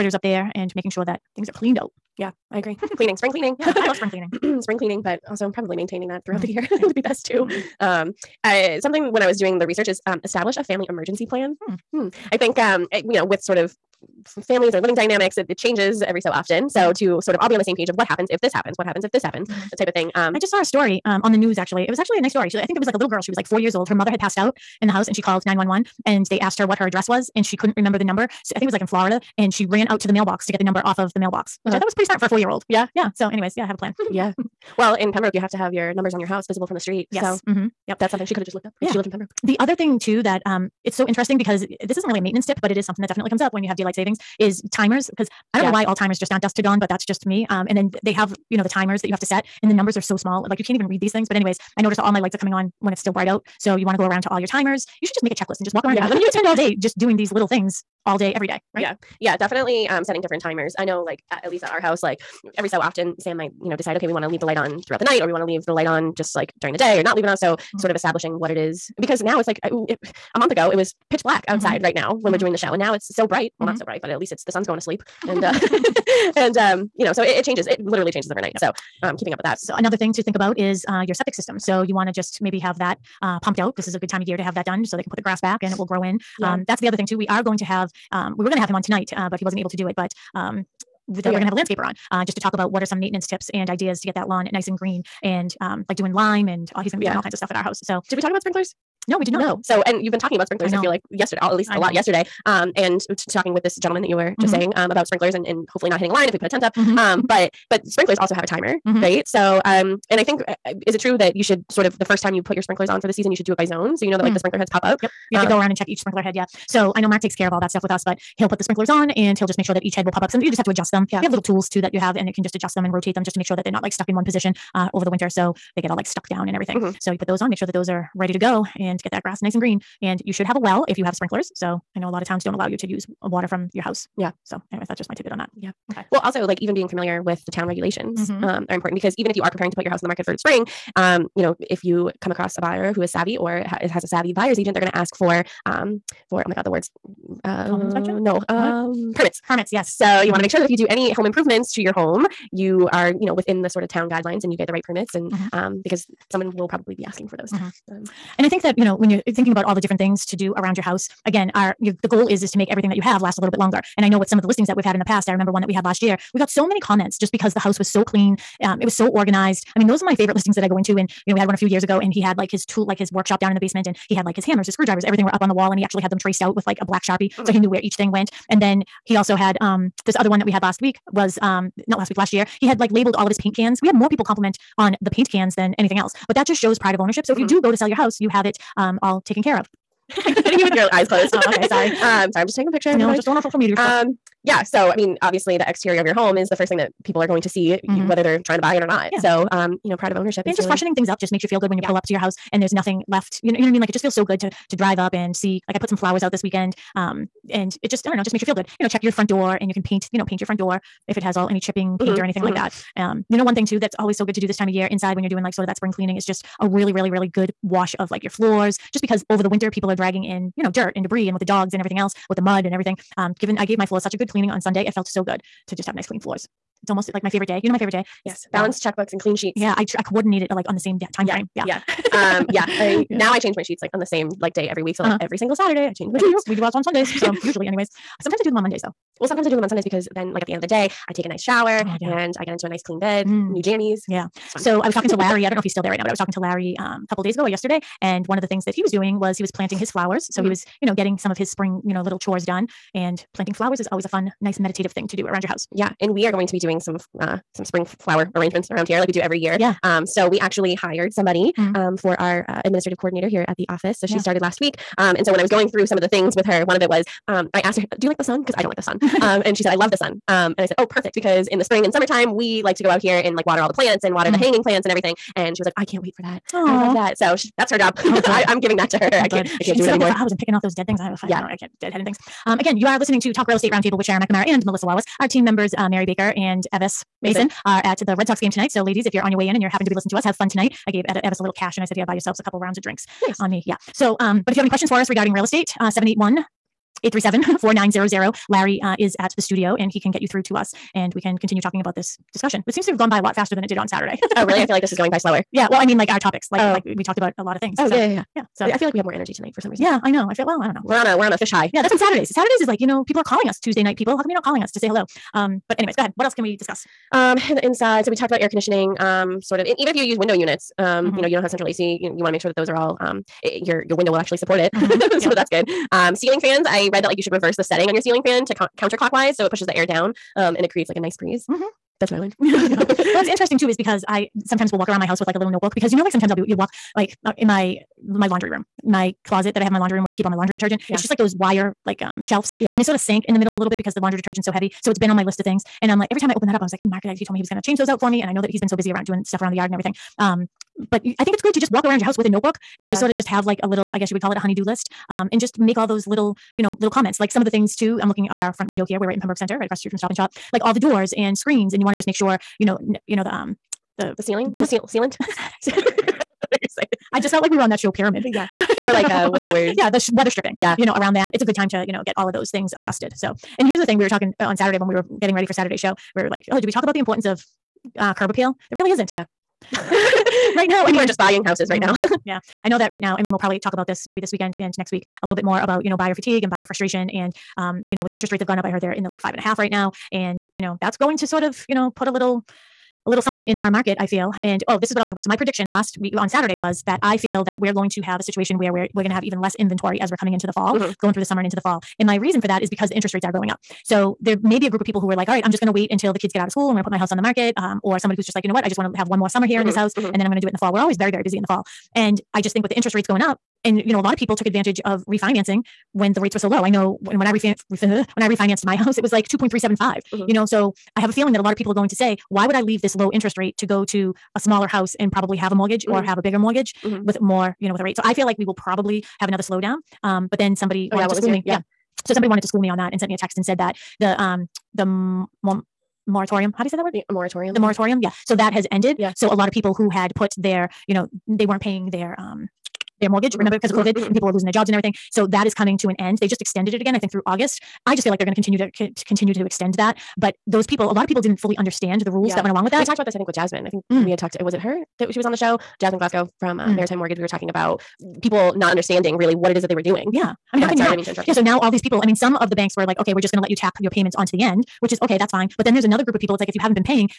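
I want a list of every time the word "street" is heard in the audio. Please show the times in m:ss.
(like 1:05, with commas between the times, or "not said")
0:36, 5:59.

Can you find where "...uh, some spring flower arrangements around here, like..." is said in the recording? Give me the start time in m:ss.
4:17.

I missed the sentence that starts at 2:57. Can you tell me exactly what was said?
he knew where each thing went.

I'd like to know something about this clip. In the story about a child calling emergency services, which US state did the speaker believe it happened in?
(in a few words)
Florida.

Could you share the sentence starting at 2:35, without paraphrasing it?
um, because someone will probably be asking for those.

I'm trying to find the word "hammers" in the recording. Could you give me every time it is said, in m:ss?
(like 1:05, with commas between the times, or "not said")
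2:54.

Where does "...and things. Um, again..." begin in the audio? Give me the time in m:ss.
4:41.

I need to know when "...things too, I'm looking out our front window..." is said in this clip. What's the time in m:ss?
5:57.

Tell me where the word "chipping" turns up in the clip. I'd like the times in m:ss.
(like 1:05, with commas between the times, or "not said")
3:31.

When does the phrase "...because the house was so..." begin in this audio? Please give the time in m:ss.
2:47.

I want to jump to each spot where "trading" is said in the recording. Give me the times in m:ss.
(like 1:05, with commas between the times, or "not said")
not said.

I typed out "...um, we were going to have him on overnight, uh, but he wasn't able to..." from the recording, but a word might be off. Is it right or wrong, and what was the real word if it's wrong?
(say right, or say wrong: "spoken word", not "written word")
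wrong: "tonight", not "overnight".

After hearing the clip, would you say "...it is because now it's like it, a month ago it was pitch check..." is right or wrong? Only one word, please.
wrong.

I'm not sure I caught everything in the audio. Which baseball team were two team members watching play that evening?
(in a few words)
Red Sox.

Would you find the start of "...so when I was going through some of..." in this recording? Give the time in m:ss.
4:25.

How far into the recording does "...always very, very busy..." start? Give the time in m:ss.
6:50.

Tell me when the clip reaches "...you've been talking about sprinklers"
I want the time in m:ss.
1:40.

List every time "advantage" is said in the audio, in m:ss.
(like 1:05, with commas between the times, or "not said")
6:54.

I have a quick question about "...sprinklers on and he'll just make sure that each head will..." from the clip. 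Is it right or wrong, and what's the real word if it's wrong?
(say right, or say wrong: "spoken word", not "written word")
right.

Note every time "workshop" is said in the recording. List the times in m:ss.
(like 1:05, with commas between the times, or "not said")
2:53.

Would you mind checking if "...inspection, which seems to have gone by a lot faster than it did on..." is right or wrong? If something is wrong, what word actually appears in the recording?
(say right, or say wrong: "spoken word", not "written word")
wrong: "discussion", not "inspection".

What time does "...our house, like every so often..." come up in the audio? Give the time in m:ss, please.
1:01.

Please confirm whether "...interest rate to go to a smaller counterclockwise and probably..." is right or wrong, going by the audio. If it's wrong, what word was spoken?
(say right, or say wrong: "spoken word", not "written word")
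wrong: "house", not "counterclockwise".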